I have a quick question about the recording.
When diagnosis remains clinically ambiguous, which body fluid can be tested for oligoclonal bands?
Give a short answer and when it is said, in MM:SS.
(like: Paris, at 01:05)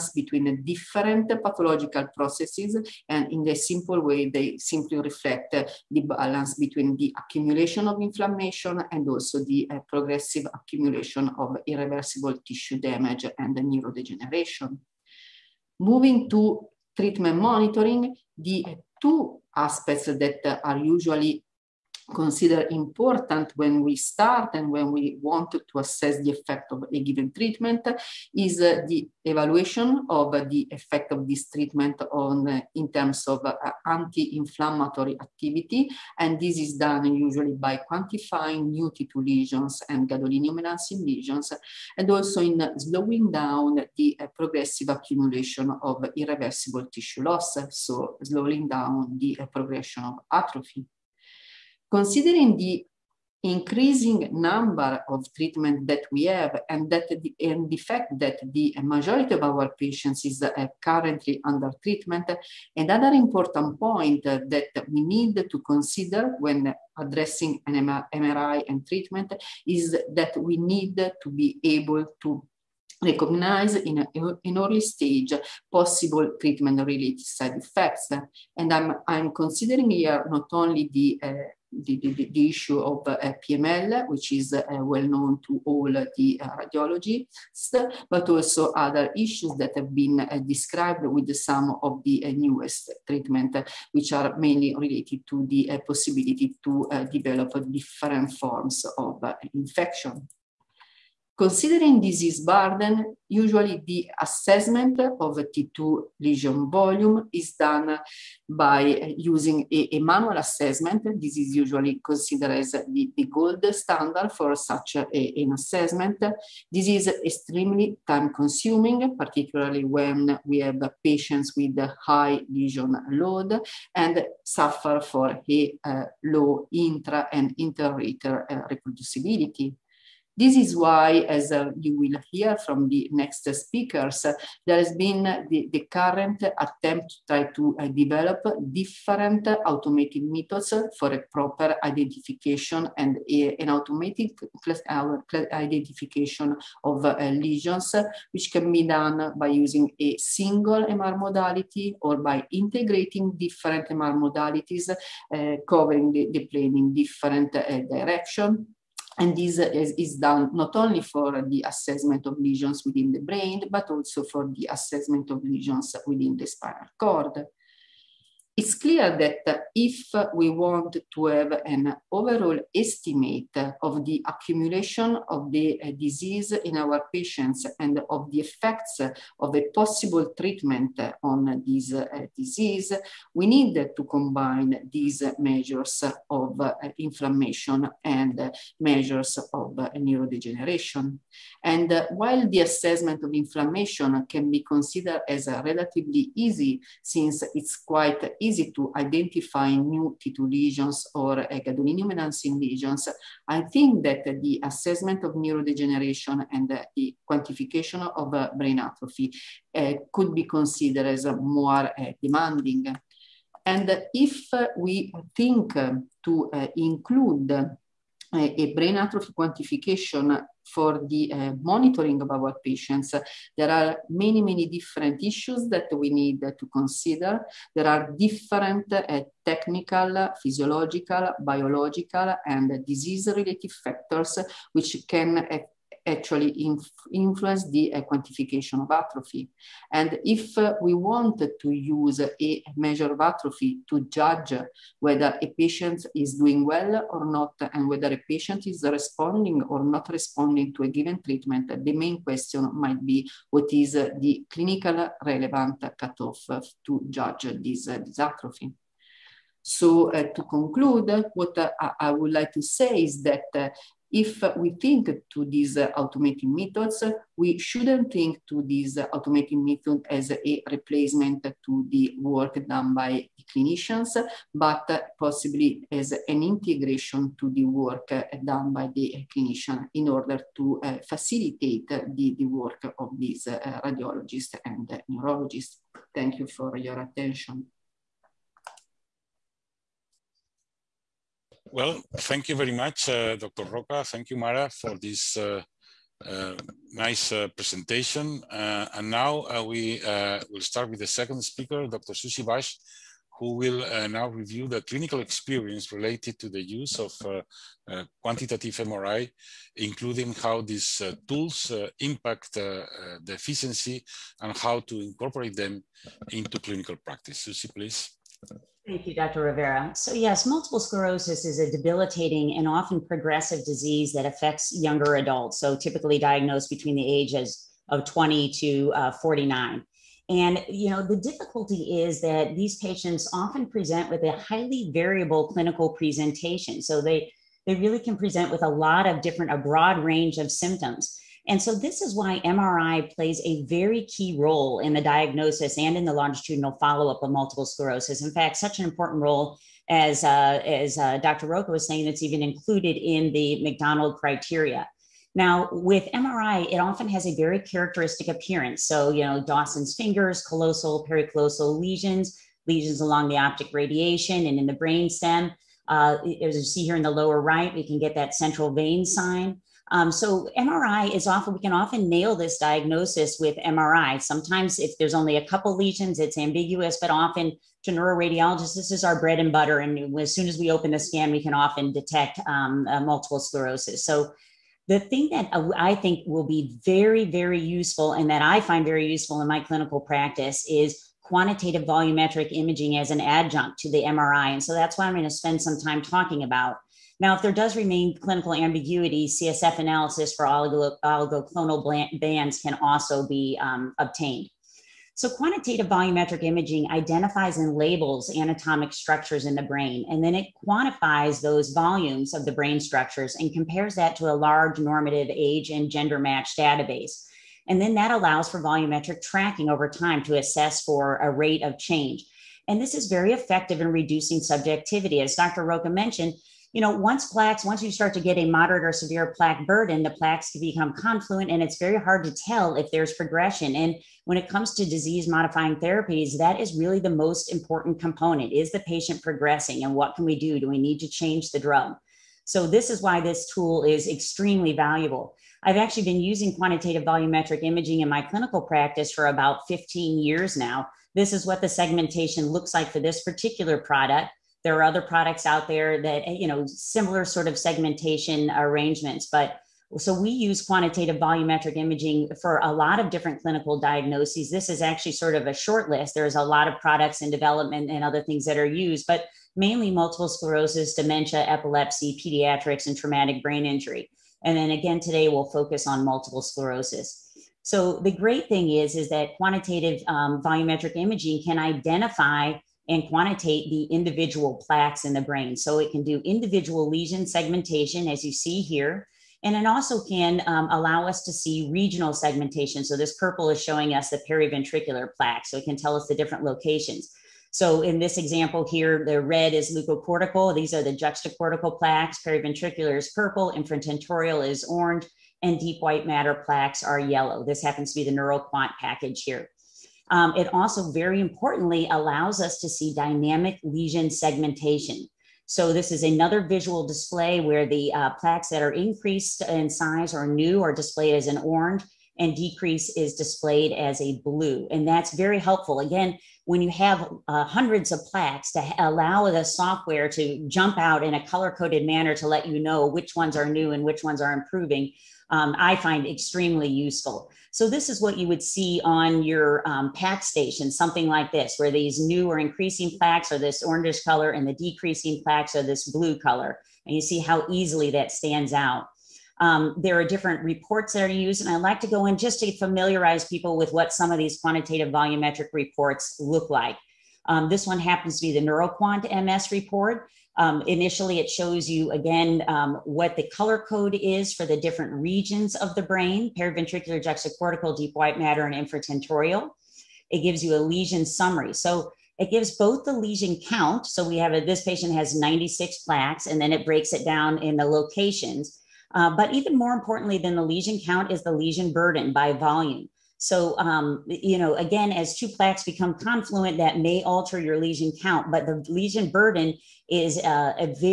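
CSF, at 06:39.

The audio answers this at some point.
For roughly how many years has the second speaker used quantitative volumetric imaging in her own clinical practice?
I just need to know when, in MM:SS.
07:29.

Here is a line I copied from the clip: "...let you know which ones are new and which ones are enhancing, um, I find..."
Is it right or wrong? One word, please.
wrong.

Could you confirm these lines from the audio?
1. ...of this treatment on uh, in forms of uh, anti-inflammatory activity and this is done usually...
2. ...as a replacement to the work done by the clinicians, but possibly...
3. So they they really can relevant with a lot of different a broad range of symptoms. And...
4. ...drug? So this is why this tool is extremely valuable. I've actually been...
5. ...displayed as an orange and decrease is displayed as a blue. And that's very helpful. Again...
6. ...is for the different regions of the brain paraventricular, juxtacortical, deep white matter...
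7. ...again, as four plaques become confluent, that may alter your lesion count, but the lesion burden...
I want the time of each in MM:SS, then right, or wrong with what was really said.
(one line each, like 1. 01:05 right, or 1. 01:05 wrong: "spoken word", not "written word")
1. 00:31 wrong: "terms", not "forms"
2. 04:30 right
3. 05:36 wrong: "present", not "relevant"
4. 07:21 right
5. 08:40 right
6. 09:23 right
7. 09:44 wrong: "two", not "four".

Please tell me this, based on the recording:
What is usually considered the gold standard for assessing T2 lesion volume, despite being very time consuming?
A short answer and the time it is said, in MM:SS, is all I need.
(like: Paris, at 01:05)
Manual assessment, at 01:50.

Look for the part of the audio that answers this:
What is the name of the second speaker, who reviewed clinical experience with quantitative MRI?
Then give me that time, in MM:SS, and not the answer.
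05:02.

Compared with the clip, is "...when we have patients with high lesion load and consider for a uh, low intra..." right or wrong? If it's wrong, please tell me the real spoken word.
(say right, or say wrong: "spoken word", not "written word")
wrong: "suffer", not "consider".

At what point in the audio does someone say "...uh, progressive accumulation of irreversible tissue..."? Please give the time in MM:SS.
00:09.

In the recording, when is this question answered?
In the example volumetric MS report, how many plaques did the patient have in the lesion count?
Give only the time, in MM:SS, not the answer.
09:35.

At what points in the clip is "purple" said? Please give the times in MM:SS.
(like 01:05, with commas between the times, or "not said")
08:13, 08:23.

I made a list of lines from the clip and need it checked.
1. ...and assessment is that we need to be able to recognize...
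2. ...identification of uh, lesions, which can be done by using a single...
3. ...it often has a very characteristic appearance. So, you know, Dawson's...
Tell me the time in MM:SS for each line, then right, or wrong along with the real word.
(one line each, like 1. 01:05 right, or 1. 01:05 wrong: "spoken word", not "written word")
1. 01:08 wrong: "treatment", not "assessment"
2. 02:25 right
3. 05:56 right.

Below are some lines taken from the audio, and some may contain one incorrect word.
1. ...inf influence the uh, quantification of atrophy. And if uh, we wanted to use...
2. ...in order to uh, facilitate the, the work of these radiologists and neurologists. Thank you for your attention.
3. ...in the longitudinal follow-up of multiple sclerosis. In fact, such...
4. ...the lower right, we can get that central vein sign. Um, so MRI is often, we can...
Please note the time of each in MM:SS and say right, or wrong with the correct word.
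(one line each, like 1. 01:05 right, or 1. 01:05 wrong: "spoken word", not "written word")
1. 03:56 right
2. 04:39 right
3. 05:45 right
4. 06:07 right.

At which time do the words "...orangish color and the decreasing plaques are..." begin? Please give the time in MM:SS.
09:03.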